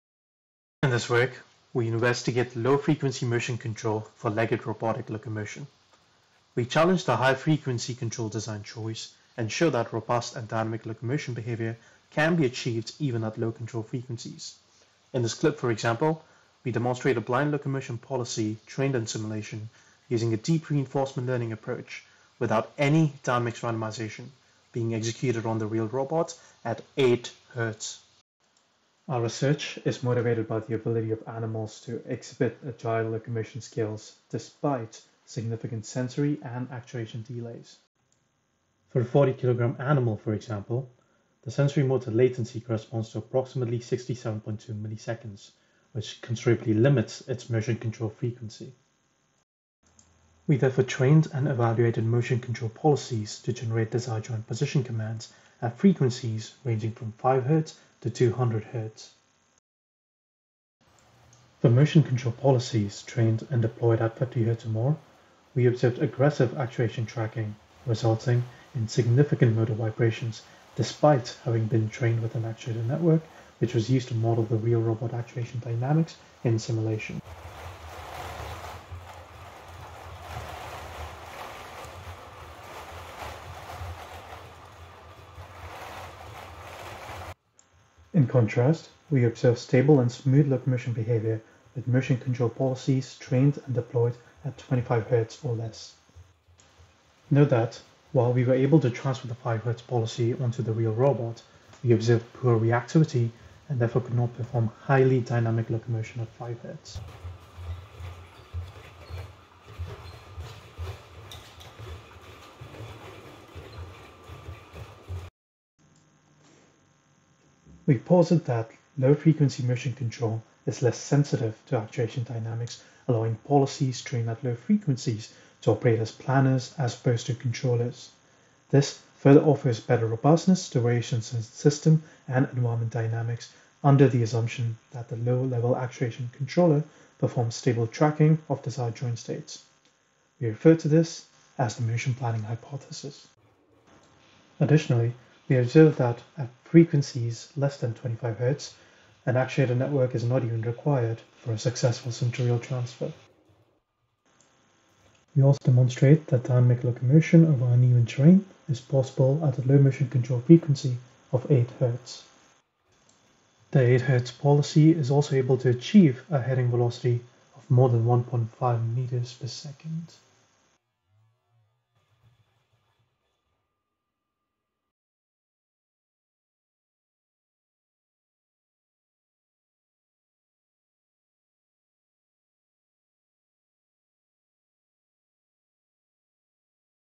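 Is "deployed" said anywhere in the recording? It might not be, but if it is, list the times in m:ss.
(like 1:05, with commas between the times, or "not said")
1:03, 1:33.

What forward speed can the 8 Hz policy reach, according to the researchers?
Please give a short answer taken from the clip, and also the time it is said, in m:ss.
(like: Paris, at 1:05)
more than 1.5 m/s, at 2:47.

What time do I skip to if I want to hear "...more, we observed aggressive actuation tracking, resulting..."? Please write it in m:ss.
1:04.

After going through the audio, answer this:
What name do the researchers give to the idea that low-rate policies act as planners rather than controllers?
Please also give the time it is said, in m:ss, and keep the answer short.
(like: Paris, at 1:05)
motion planning hypothesis, at 2:21.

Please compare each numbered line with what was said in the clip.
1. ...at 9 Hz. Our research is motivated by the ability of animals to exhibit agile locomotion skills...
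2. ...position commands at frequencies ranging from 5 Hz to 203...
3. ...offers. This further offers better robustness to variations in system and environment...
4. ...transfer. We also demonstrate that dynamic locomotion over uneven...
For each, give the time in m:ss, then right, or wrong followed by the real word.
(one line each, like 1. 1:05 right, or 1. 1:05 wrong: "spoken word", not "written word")
1. 0:26 wrong: "8", not "9"
2. 0:54 wrong: "200", not "203"
3. 2:07 wrong: "controllers", not "offers"
4. 2:32 right.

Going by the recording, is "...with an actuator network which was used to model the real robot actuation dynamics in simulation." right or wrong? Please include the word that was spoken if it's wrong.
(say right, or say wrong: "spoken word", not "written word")
right.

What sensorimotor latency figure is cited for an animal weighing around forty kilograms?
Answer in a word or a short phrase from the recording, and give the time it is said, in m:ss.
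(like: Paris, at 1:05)
67.2 milliseconds, at 0:43.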